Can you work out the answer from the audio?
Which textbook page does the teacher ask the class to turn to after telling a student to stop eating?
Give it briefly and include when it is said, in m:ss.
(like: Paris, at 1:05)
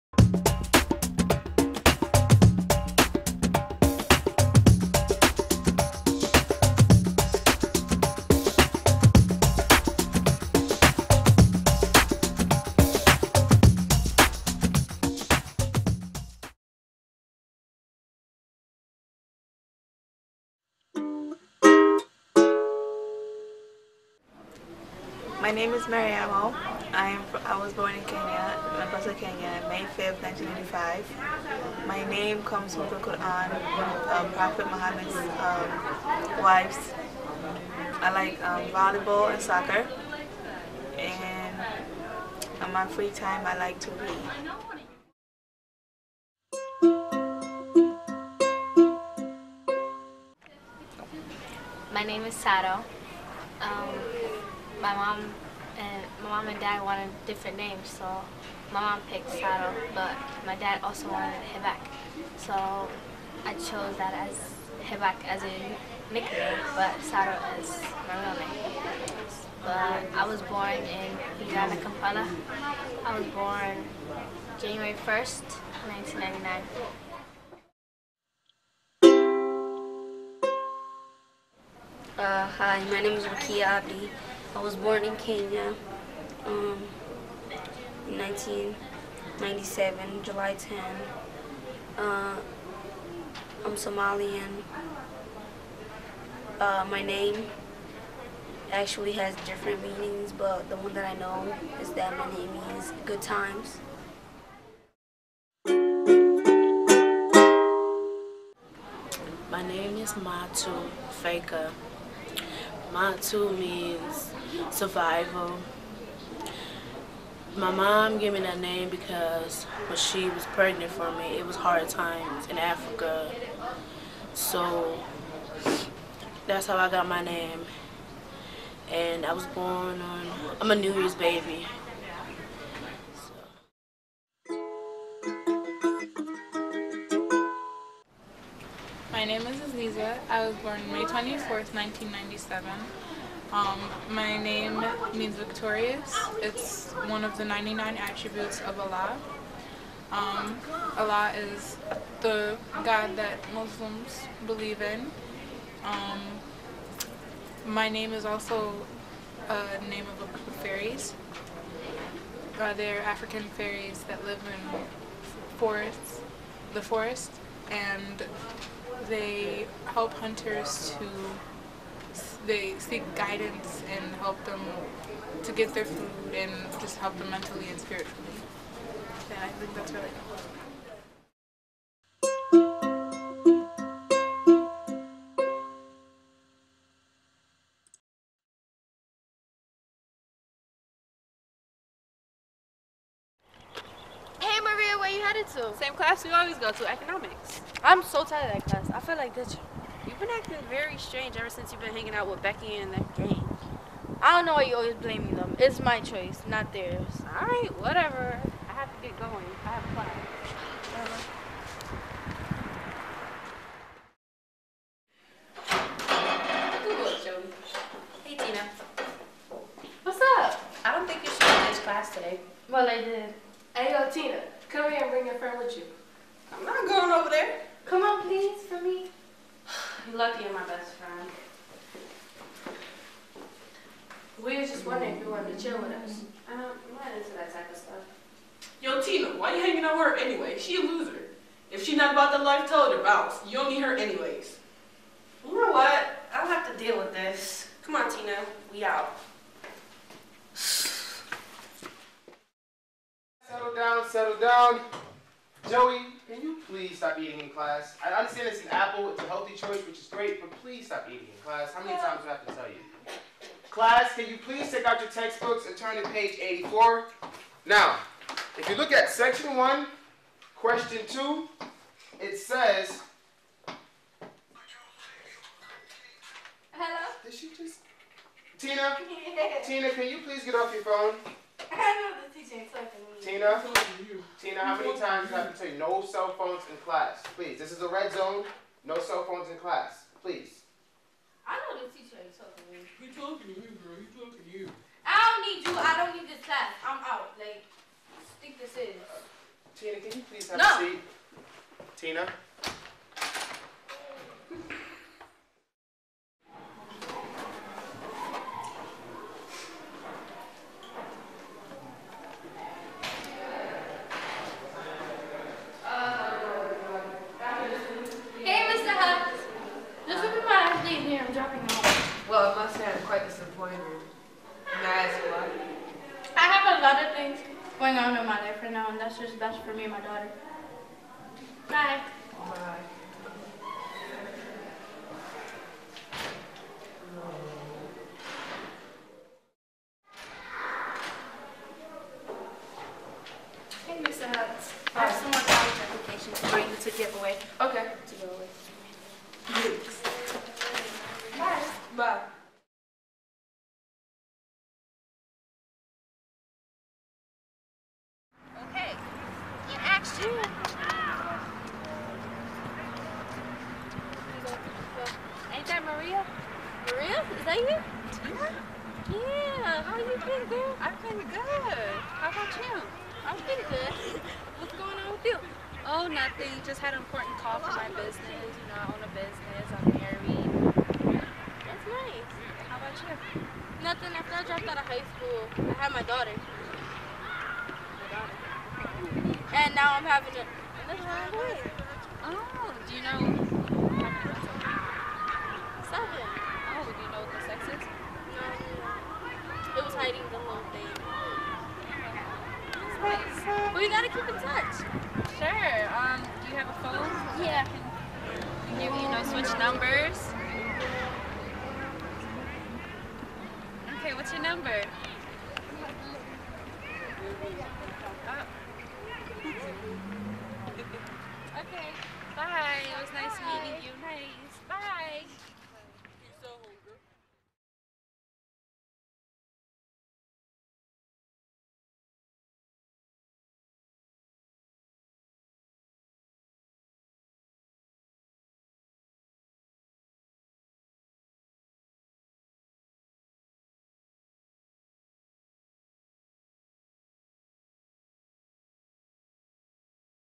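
84, at 4:26.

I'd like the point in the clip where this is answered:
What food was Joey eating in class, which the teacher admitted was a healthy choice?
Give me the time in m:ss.
4:18.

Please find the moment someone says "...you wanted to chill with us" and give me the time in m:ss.
3:55.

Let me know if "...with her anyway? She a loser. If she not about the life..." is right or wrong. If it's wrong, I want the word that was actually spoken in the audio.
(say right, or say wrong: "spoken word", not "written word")
right.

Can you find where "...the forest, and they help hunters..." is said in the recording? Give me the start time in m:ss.
2:46.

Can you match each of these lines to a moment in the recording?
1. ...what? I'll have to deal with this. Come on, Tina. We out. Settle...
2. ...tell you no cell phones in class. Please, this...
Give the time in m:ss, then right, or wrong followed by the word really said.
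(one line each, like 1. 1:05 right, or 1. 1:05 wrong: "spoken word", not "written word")
1. 4:05 right
2. 4:45 right.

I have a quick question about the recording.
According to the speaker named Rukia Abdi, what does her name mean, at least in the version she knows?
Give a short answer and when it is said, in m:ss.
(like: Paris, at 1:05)
good times, at 1:43.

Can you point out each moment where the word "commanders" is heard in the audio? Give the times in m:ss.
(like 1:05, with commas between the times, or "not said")
not said.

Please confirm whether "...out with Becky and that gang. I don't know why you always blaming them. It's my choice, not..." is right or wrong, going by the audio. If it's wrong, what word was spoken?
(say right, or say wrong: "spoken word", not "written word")
right.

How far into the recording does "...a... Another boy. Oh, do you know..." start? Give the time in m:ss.
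6:30.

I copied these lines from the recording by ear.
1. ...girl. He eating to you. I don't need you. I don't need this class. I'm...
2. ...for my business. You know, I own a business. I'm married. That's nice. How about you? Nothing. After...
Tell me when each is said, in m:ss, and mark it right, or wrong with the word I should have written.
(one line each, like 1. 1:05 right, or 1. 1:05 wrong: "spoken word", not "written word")
1. 4:53 wrong: "talking", not "eating"
2. 6:17 right.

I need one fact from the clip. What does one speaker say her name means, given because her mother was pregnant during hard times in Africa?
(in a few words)
survival.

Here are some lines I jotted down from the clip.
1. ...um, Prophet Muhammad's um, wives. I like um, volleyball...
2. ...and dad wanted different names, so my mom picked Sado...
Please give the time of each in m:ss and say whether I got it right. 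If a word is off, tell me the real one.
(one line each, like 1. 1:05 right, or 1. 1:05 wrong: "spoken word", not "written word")
1. 0:34 right
2. 0:56 right.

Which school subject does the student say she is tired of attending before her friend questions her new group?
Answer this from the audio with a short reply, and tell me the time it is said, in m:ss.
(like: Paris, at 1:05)
economics, at 3:16.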